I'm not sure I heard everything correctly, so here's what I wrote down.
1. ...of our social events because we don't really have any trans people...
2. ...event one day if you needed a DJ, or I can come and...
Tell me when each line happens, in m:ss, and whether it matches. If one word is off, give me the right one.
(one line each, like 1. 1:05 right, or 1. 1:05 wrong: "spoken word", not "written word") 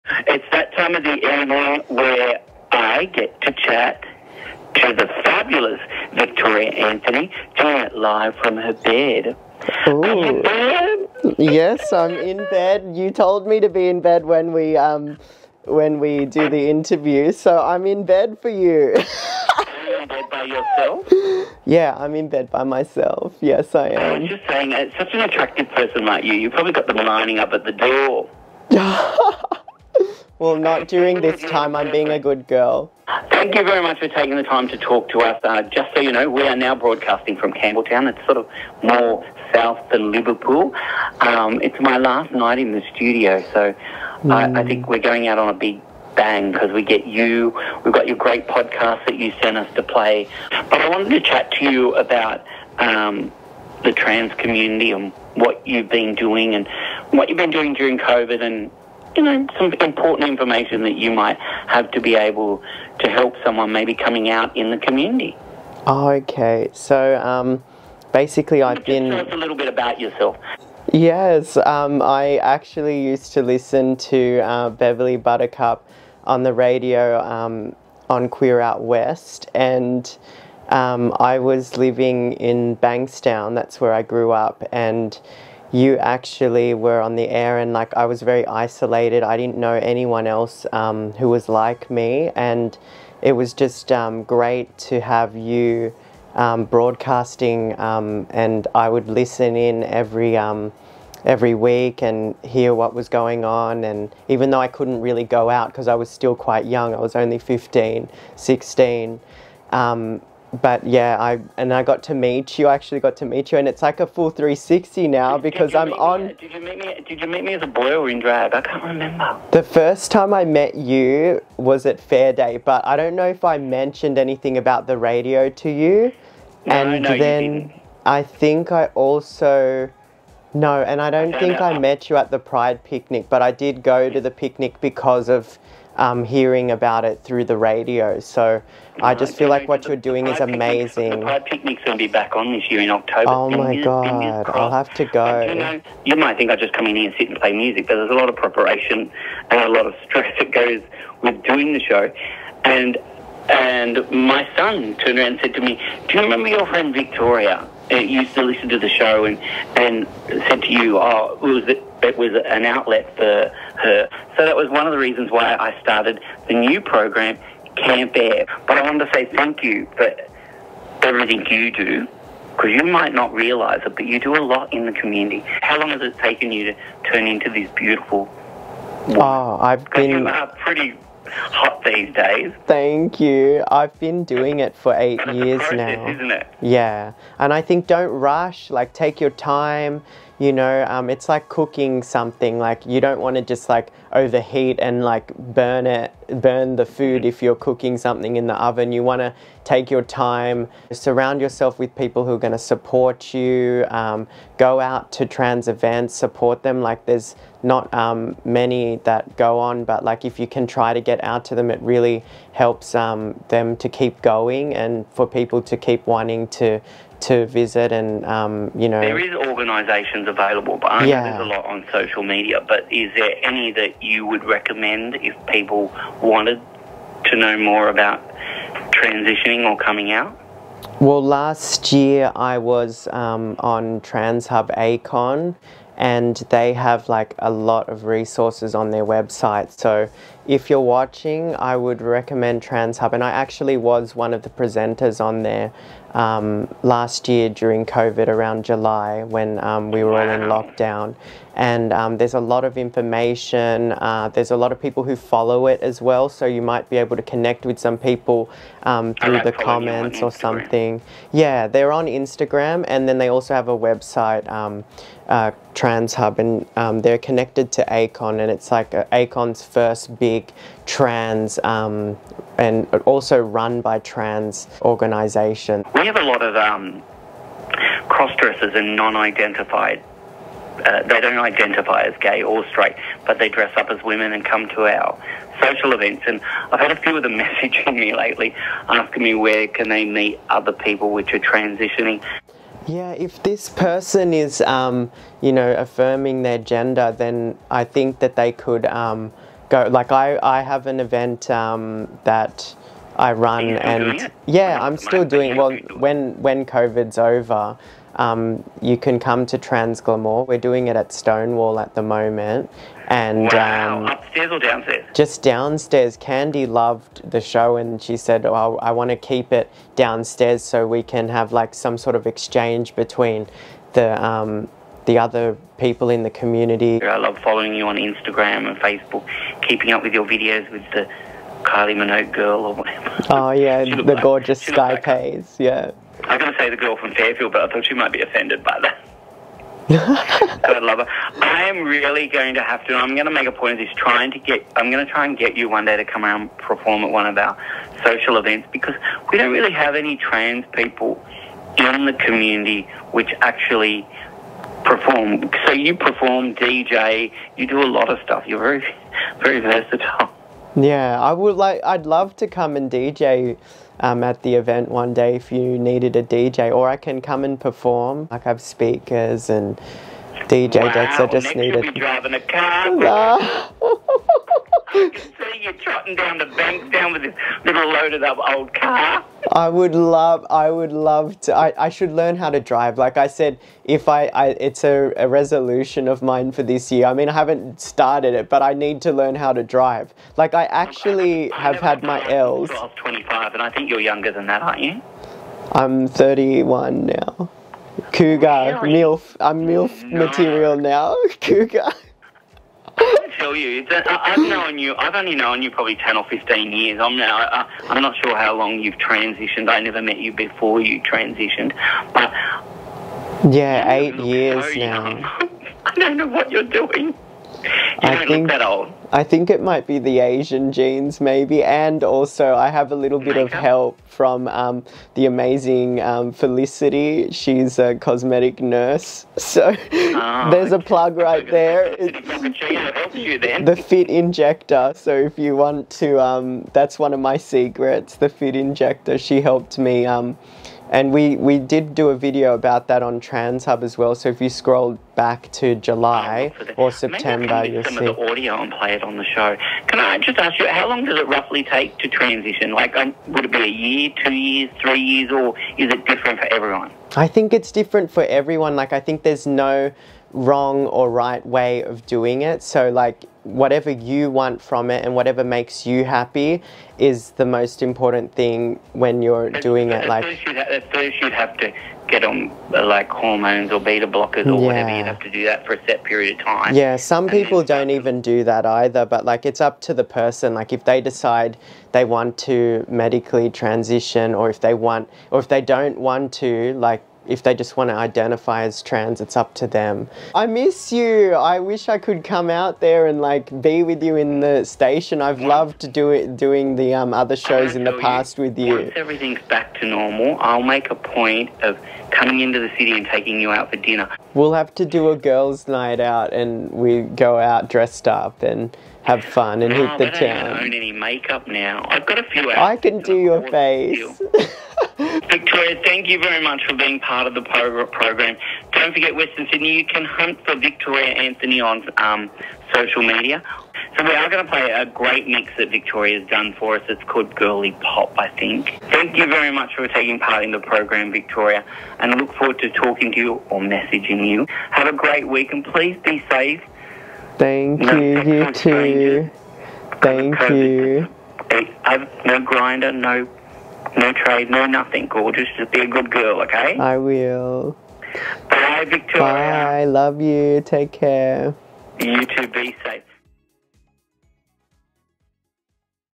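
1. 5:47 right
2. 6:04 right.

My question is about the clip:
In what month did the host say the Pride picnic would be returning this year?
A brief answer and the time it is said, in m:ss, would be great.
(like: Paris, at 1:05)
October, at 2:22.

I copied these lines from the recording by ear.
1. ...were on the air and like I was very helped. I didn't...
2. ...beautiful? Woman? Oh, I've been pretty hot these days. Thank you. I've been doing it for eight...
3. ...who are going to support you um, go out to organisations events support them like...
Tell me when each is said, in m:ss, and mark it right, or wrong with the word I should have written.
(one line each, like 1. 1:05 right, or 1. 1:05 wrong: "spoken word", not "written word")
1. 1:26 wrong: "isolated", not "helped"
2. 2:57 right
3. 3:22 wrong: "trans", not "organisations".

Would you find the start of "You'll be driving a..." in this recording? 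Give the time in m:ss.
6:11.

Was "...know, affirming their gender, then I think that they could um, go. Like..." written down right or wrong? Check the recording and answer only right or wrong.
right.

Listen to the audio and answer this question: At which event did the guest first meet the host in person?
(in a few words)
Fair Day.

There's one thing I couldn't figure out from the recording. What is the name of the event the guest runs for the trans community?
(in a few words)
Trans Glamour.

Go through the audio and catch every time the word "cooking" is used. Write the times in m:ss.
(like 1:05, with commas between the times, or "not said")
3:11, 3:17.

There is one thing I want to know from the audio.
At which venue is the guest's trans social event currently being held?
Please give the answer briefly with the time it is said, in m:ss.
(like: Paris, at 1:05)
Stonewall, at 5:11.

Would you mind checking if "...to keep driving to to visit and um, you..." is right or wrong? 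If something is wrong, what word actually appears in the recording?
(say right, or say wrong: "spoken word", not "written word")
wrong: "wanting", not "driving".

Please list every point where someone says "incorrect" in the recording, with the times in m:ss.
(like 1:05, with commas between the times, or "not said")
not said.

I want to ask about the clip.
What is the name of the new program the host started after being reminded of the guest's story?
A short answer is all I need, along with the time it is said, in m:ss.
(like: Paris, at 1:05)
Camp Air, at 2:47.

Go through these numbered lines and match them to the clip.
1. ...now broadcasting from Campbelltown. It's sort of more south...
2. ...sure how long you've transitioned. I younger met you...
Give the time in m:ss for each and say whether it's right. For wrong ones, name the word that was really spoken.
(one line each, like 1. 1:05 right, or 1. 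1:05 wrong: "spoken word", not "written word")
1. 0:36 right
2. 6:48 wrong: "never", not "younger".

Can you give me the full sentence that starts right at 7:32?
Like, um, would it be a year, two years, three years, or is it different for everyone?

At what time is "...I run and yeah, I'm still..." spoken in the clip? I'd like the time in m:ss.
5:03.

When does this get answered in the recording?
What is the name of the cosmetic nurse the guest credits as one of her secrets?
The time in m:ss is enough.
7:06.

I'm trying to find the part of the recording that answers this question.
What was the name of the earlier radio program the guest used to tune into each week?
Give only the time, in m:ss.
1:18.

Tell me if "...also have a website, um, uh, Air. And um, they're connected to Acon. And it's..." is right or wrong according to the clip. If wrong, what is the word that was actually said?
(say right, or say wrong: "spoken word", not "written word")
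wrong: "TransHub", not "Air".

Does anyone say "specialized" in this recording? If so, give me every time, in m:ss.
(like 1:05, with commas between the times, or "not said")
not said.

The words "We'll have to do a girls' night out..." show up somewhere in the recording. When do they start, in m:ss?
8:24.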